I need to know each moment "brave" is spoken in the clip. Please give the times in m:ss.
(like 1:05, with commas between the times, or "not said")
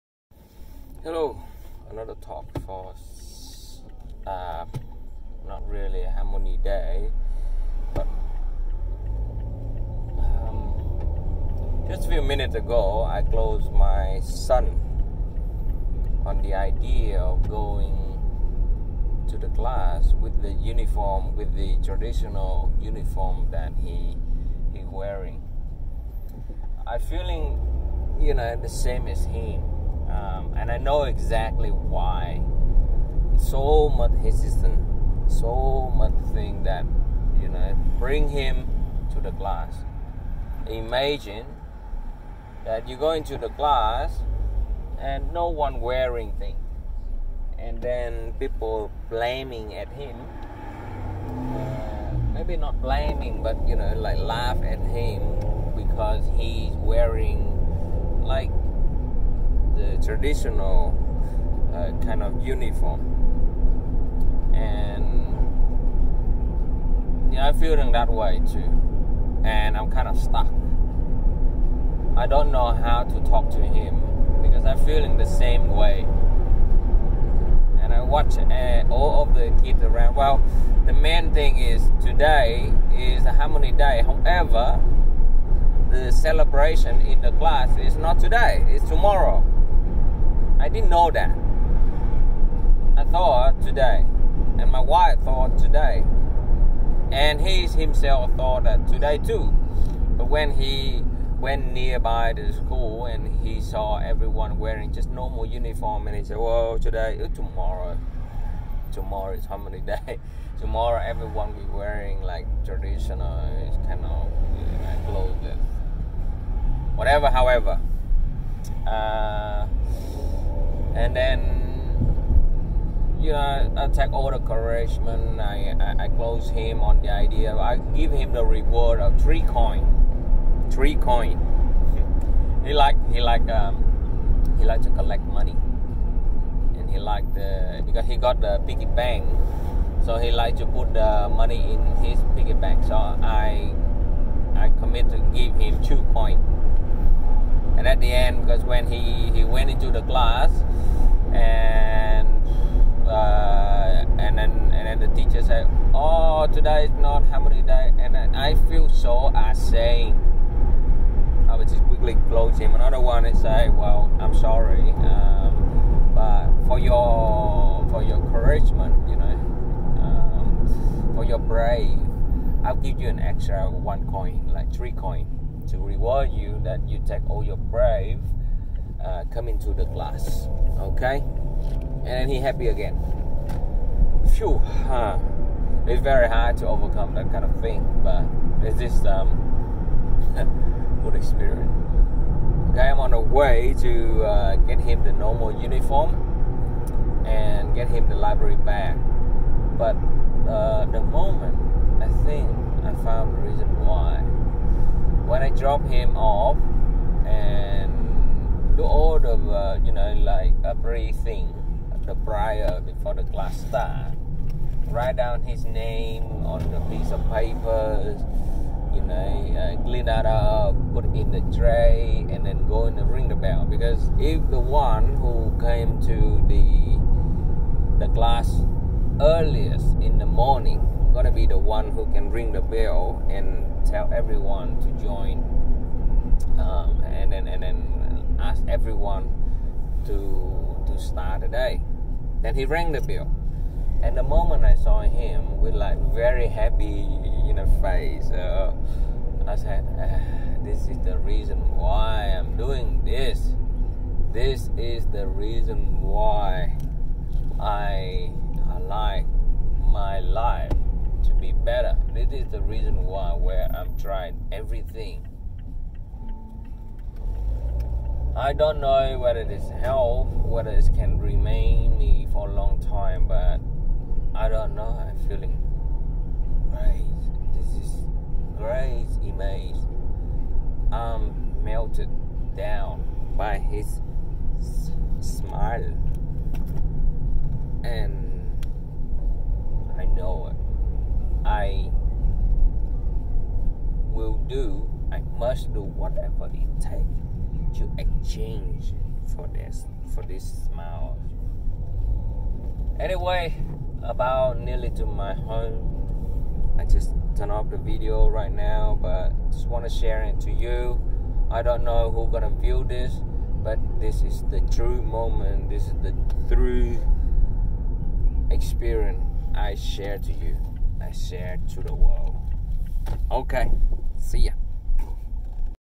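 2:51, 2:57.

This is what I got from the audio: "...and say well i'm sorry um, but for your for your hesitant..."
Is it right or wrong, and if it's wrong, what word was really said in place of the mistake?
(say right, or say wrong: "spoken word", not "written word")
wrong: "encouragement", not "hesitant".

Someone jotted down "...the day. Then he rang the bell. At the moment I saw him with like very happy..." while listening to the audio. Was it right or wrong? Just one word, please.
right.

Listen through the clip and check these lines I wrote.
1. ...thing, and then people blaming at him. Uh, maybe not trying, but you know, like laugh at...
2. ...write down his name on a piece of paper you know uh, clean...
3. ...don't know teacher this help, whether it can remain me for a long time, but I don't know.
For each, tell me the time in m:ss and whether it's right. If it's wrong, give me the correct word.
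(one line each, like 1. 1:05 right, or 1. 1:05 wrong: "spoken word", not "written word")
1. 0:46 wrong: "blaming", not "trying"
2. 3:34 right
3. 4:28 wrong: "whether", not "teacher".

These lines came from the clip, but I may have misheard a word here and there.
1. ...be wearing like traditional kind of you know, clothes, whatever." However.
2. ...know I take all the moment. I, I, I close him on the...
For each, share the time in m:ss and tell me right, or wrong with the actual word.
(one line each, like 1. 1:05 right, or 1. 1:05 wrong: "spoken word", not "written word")
1. 1:51 right
2. 2:03 wrong: "encouragement", not "moment".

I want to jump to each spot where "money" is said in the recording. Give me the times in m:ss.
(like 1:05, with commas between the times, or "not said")
2:15, 2:21.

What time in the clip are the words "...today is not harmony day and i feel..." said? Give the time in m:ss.
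2:36.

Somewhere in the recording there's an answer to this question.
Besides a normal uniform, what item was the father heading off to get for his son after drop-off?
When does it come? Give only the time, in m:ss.
3:18.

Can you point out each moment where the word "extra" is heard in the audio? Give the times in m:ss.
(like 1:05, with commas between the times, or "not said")
2:53.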